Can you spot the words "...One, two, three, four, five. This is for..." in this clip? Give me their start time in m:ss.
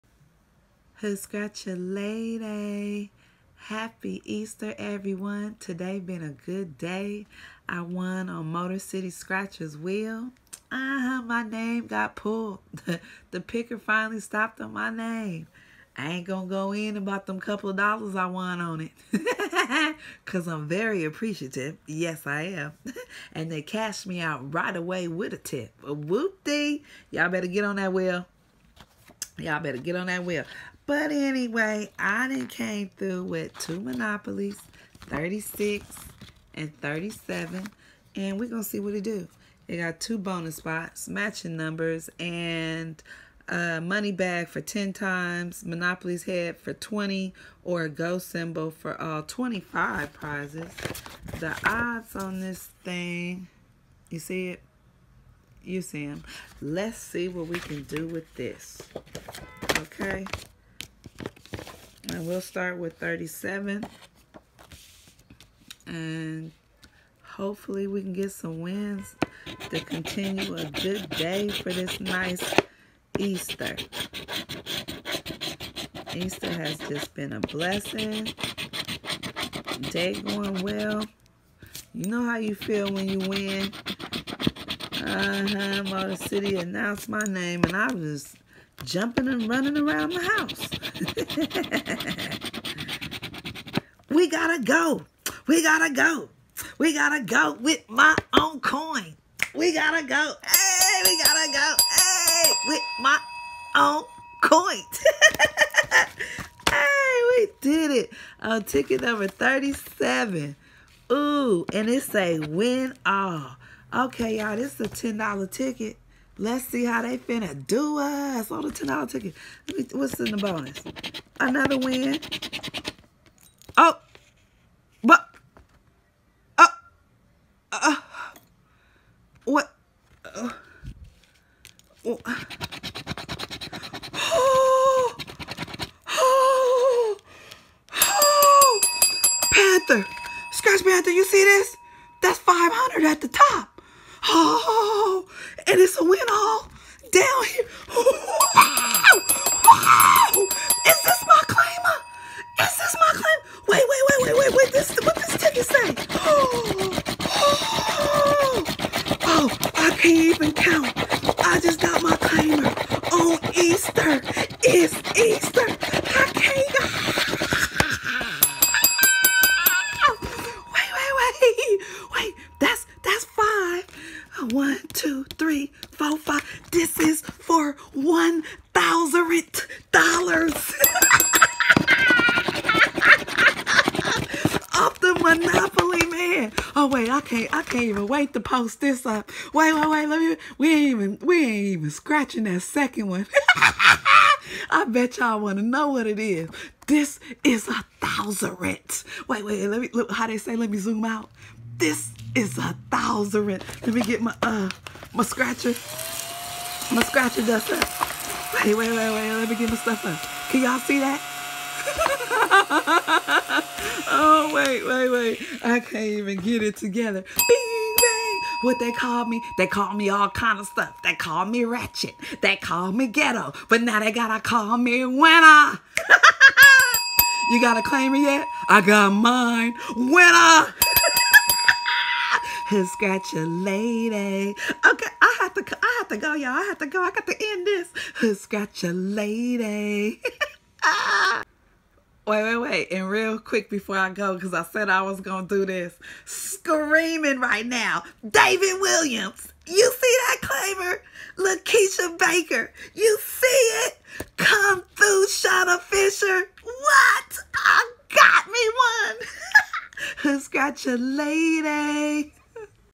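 2:54.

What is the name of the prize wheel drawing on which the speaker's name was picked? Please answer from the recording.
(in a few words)
Motor City Scratchers Wheel.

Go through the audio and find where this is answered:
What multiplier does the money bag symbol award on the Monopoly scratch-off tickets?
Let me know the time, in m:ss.
0:44.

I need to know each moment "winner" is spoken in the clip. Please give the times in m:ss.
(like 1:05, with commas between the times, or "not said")
3:45, 3:49.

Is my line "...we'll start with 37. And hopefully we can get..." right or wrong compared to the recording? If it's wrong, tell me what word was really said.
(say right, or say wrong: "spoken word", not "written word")
right.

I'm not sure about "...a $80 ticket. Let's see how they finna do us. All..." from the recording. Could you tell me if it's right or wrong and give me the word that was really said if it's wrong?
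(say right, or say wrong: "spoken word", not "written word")
wrong: "10", not "80".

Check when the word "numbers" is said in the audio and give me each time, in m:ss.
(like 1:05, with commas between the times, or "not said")
0:41, 1:49.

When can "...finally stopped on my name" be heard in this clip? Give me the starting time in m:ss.
0:13.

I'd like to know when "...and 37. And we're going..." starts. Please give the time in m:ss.
0:36.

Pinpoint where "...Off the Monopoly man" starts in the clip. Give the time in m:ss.
3:04.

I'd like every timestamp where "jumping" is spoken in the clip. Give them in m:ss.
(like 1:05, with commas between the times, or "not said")
1:28.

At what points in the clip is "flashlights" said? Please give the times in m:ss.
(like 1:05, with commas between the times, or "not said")
not said.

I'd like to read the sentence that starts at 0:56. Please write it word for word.
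Let's see what we can do with this.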